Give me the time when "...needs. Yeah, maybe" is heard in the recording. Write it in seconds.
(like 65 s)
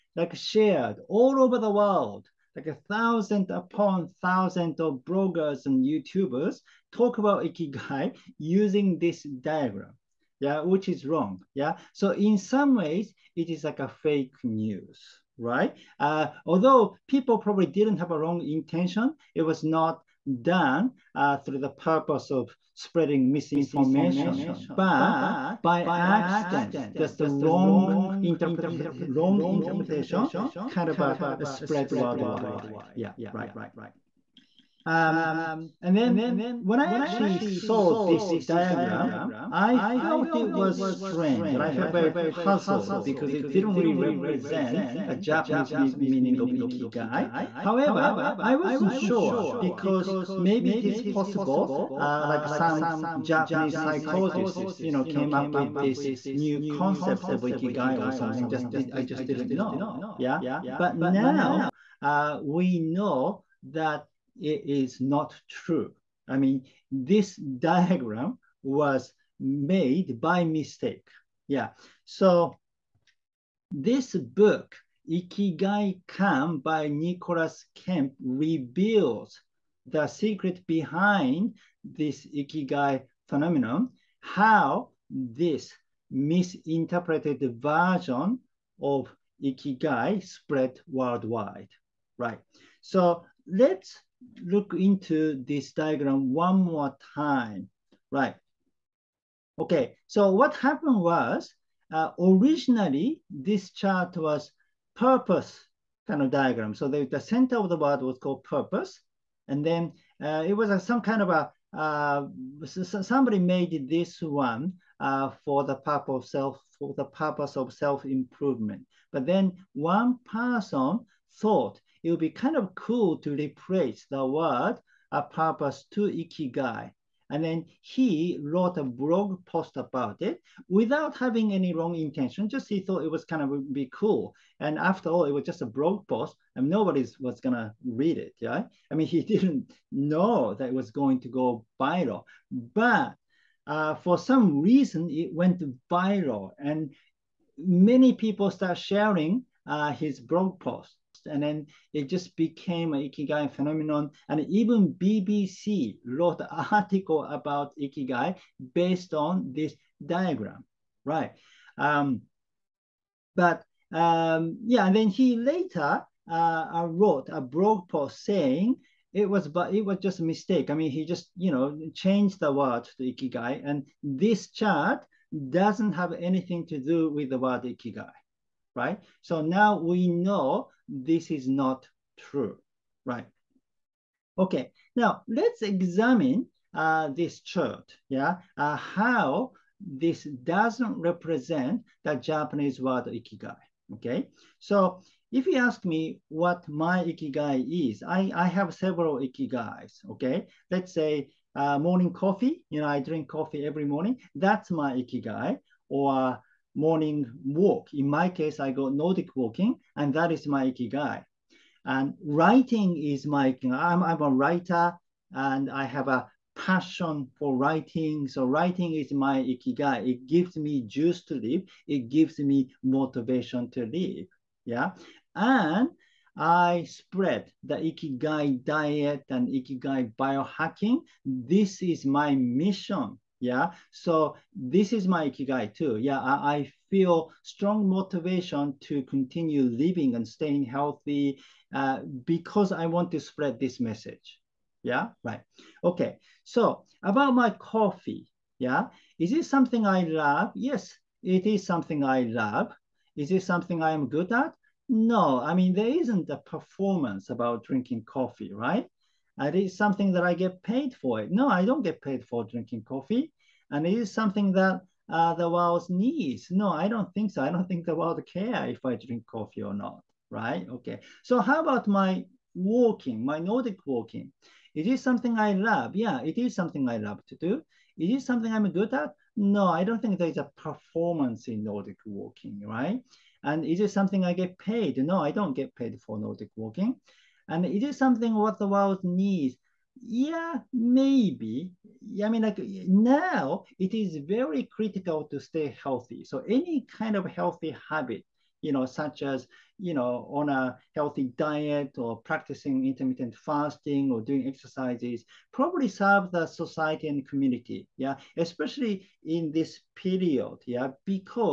289 s.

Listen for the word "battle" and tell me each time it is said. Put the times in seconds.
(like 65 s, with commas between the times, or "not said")
not said.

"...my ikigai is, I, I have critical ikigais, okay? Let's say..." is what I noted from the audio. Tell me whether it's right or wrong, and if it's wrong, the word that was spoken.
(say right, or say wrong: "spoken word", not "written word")
wrong: "several", not "critical".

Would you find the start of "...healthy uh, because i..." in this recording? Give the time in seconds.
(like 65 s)
240 s.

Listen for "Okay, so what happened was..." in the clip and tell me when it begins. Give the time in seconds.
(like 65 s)
99 s.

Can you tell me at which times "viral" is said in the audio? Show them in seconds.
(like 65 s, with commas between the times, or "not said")
141 s, 145 s.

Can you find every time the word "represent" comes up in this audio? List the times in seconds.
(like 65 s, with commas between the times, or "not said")
43 s, 190 s.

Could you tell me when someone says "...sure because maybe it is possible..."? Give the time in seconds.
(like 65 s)
48 s.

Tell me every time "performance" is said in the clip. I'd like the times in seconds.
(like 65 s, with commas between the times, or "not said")
256 s, 280 s.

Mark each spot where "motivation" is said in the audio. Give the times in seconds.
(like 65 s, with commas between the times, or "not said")
222 s, 237 s.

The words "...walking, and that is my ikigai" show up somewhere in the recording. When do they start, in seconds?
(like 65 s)
209 s.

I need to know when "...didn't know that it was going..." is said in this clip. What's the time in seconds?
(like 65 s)
139 s.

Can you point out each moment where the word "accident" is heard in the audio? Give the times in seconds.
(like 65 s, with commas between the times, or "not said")
25 s.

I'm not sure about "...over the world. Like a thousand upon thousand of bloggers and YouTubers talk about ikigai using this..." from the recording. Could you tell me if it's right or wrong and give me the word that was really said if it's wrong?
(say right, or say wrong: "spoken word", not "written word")
right.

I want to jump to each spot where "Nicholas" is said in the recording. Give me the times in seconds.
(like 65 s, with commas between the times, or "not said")
76 s.